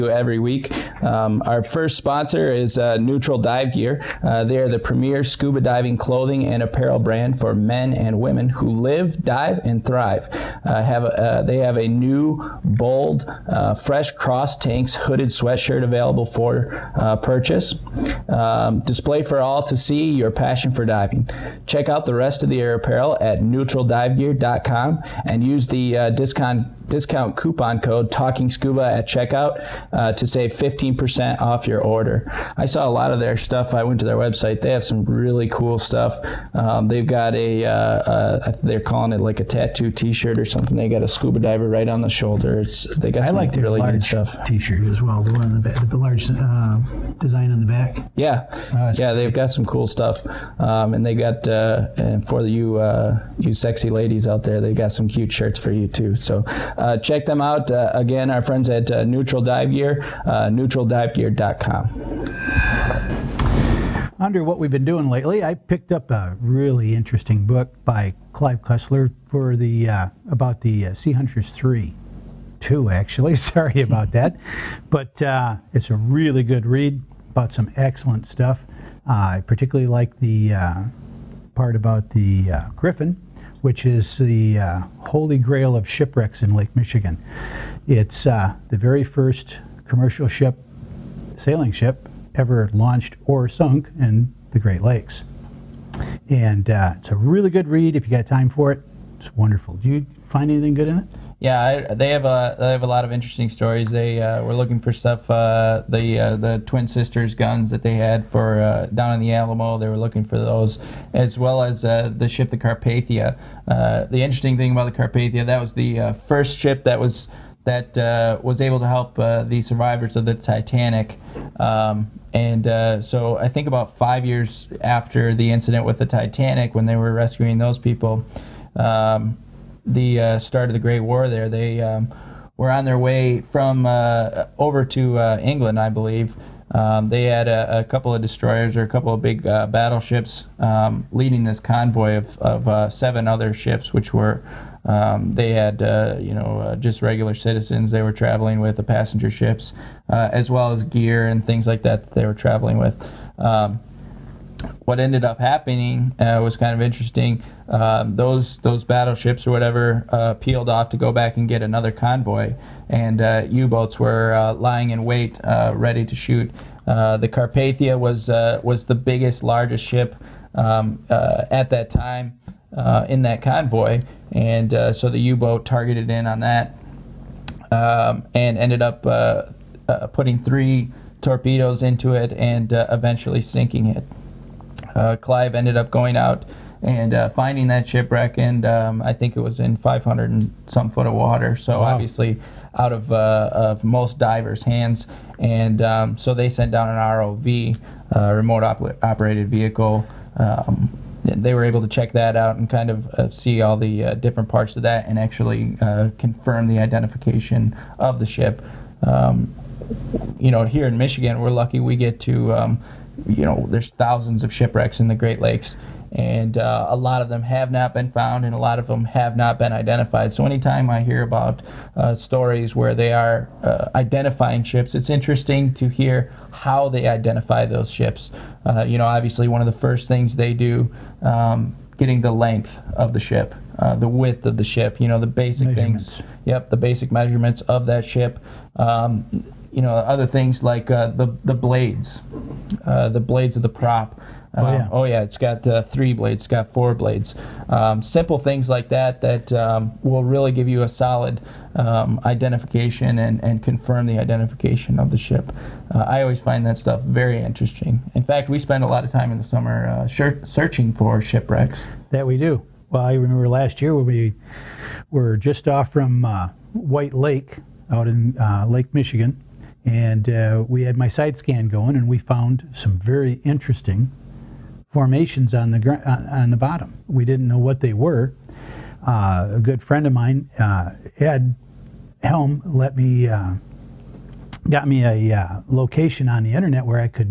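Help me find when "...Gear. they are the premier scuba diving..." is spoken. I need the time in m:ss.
0:03.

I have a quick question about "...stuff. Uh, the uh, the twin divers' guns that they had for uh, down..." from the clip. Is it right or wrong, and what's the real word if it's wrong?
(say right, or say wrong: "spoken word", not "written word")
wrong: "sisters", not "divers".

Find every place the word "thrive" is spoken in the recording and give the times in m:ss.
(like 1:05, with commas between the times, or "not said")
0:09.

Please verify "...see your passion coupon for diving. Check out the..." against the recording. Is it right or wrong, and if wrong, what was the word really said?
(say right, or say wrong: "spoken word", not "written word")
wrong: "passion", not "coupon".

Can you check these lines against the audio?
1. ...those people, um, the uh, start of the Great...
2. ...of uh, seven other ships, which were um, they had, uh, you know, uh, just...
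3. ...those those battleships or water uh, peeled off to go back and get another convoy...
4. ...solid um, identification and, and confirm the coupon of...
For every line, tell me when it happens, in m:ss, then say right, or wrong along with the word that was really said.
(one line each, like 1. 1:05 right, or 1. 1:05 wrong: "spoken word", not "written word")
1. 2:07 right
2. 2:22 right
3. 2:38 wrong: "whatever", not "water"
4. 4:10 wrong: "identification", not "coupon".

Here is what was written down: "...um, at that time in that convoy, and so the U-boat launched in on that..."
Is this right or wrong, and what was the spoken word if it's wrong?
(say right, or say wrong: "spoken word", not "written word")
wrong: "targeted", not "launched".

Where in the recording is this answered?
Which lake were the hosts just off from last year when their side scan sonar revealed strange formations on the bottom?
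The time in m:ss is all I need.
4:26.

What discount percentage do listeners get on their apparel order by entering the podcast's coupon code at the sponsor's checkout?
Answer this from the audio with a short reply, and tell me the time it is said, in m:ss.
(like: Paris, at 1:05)
15%, at 0:30.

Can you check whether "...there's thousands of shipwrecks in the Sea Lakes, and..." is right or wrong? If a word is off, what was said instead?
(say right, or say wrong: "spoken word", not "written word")
wrong: "Great", not "Sea".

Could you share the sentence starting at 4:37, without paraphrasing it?
We didn't know what they were.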